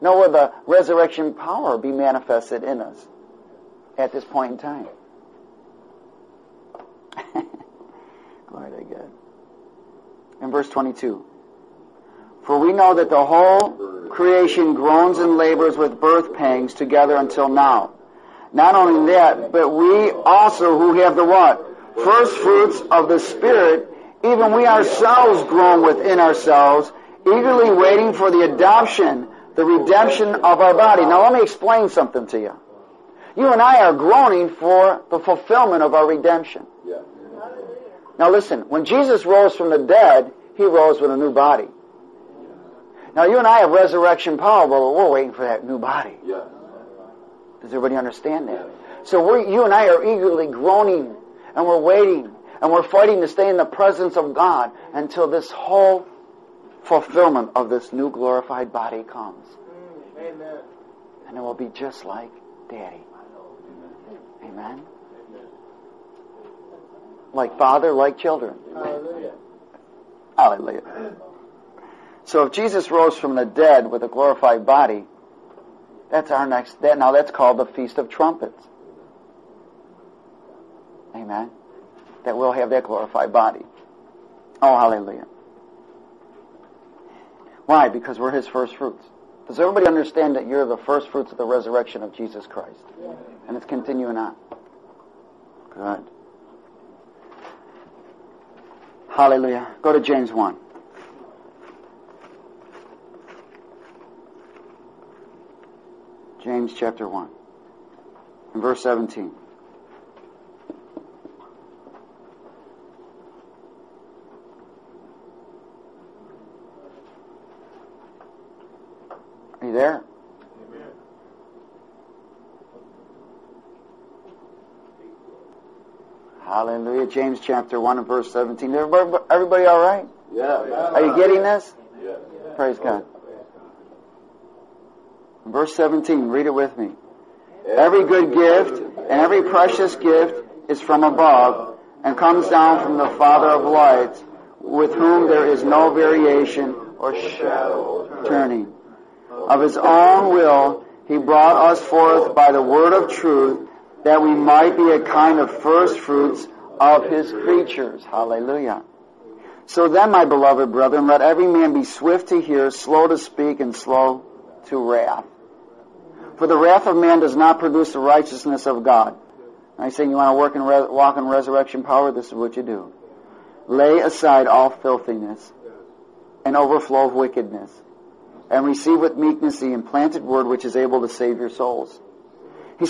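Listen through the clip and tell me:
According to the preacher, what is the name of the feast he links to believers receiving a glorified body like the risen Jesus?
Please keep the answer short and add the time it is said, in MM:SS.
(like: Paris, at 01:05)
Feast of Trumpets, at 01:17.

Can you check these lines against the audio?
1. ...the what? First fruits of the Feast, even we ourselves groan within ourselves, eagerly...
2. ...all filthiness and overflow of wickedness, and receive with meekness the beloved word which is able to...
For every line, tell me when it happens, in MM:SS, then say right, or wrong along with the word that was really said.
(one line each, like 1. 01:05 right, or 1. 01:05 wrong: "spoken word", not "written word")
1. 00:21 wrong: "Spirit", not "Feast"
2. 02:54 wrong: "implanted", not "beloved".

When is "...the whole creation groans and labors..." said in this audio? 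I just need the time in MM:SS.
00:13.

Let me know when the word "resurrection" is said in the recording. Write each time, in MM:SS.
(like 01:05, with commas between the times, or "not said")
00:00, 00:43, 01:31, 02:51.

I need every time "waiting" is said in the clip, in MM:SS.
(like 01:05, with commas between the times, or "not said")
00:27, 00:45, 00:51.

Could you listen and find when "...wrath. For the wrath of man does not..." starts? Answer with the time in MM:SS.
02:44.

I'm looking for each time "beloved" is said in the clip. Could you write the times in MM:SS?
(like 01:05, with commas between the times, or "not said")
02:40.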